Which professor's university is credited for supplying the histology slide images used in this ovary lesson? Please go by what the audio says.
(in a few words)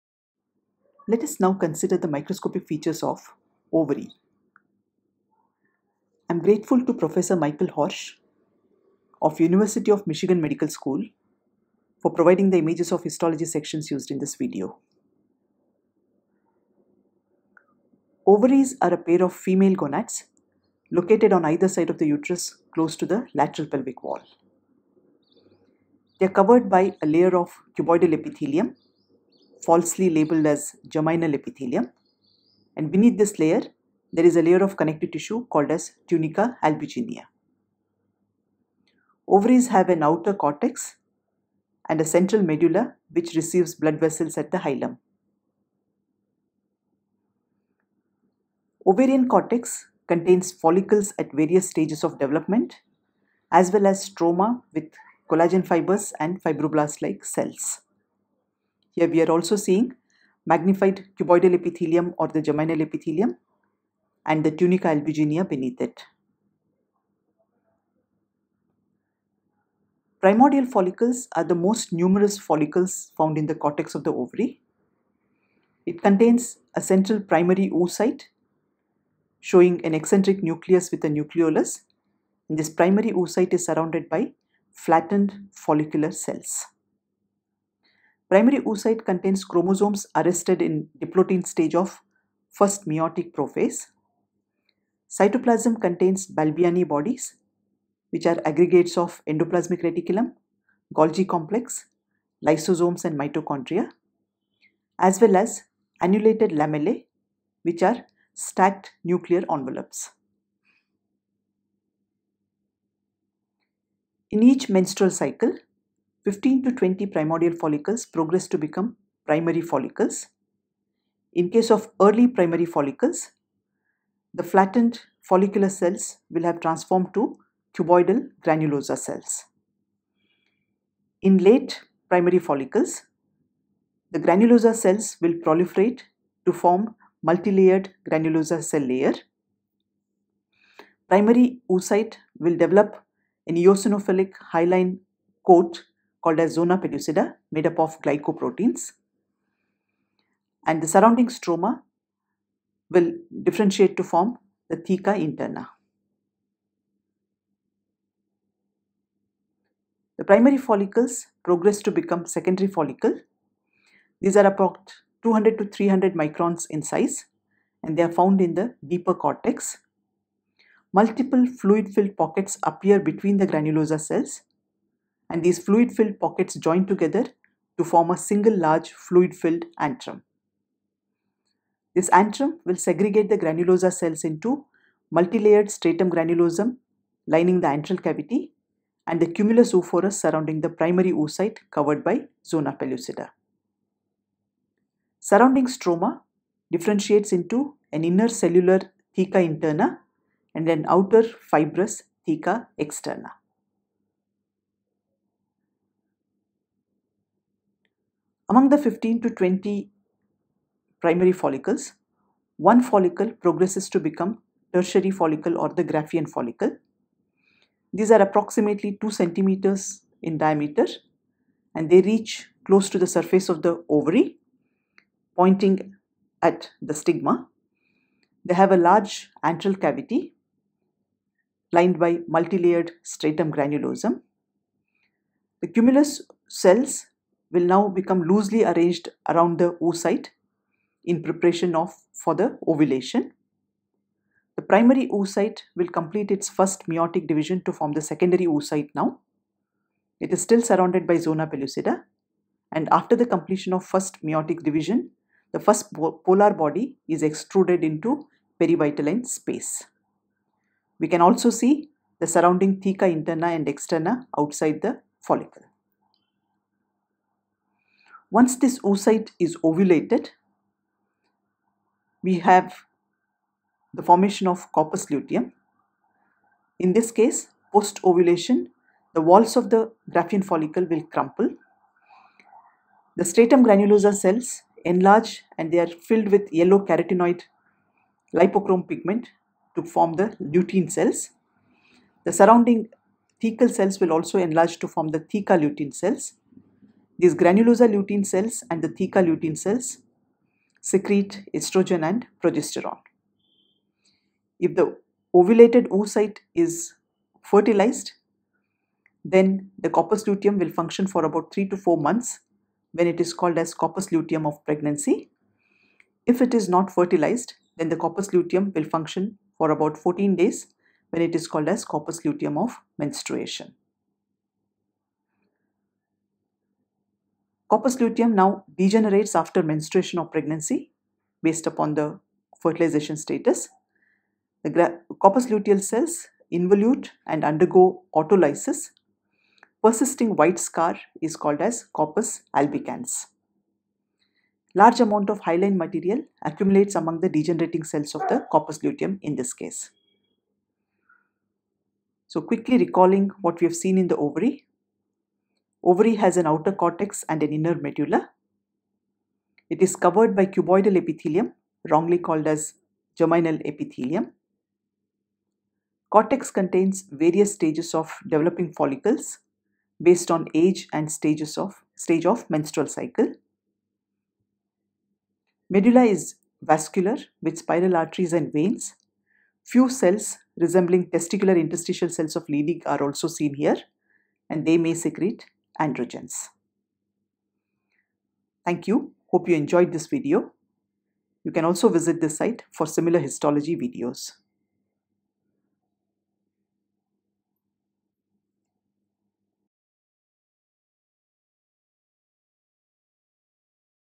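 University of Michigan.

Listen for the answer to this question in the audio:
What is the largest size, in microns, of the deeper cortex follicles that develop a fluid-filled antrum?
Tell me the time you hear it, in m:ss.
2:45.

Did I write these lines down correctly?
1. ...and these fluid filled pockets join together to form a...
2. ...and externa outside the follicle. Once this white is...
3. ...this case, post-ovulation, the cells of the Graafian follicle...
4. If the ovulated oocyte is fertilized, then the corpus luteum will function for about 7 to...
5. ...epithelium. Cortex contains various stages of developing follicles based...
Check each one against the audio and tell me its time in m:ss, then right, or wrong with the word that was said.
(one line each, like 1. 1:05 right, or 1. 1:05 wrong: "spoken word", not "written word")
1. 2:55 right
2. 4:23 wrong: "oocyte", not "white"
3. 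4:36 wrong: "walls", not "cells"
4. 5:04 wrong: "3", not "7"
5. 6:03 right.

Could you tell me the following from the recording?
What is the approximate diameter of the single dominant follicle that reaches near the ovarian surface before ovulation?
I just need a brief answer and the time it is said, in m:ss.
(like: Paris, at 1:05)
2 centimeters, at 3:38.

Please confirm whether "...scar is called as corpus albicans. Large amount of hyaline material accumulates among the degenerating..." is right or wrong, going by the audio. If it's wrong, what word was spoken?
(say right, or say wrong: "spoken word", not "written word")
right.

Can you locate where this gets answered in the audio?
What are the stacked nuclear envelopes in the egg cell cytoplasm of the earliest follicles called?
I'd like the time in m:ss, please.
1:46.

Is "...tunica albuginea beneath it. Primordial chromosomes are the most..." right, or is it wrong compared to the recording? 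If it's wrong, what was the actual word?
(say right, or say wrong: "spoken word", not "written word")
wrong: "follicles", not "chromosomes".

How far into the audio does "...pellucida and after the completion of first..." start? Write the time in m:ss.
4:11.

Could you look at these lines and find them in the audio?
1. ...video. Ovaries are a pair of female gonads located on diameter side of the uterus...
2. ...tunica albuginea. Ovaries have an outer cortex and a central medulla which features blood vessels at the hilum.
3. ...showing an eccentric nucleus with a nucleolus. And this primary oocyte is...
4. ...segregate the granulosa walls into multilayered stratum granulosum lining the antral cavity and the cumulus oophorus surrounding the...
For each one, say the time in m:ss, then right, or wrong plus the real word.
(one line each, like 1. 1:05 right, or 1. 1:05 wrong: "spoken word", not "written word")
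1. 0:14 wrong: "either", not "diameter"
2. 0:36 wrong: "receives", not "features"
3. 1:19 right
4. 3:02 wrong: "cells", not "walls".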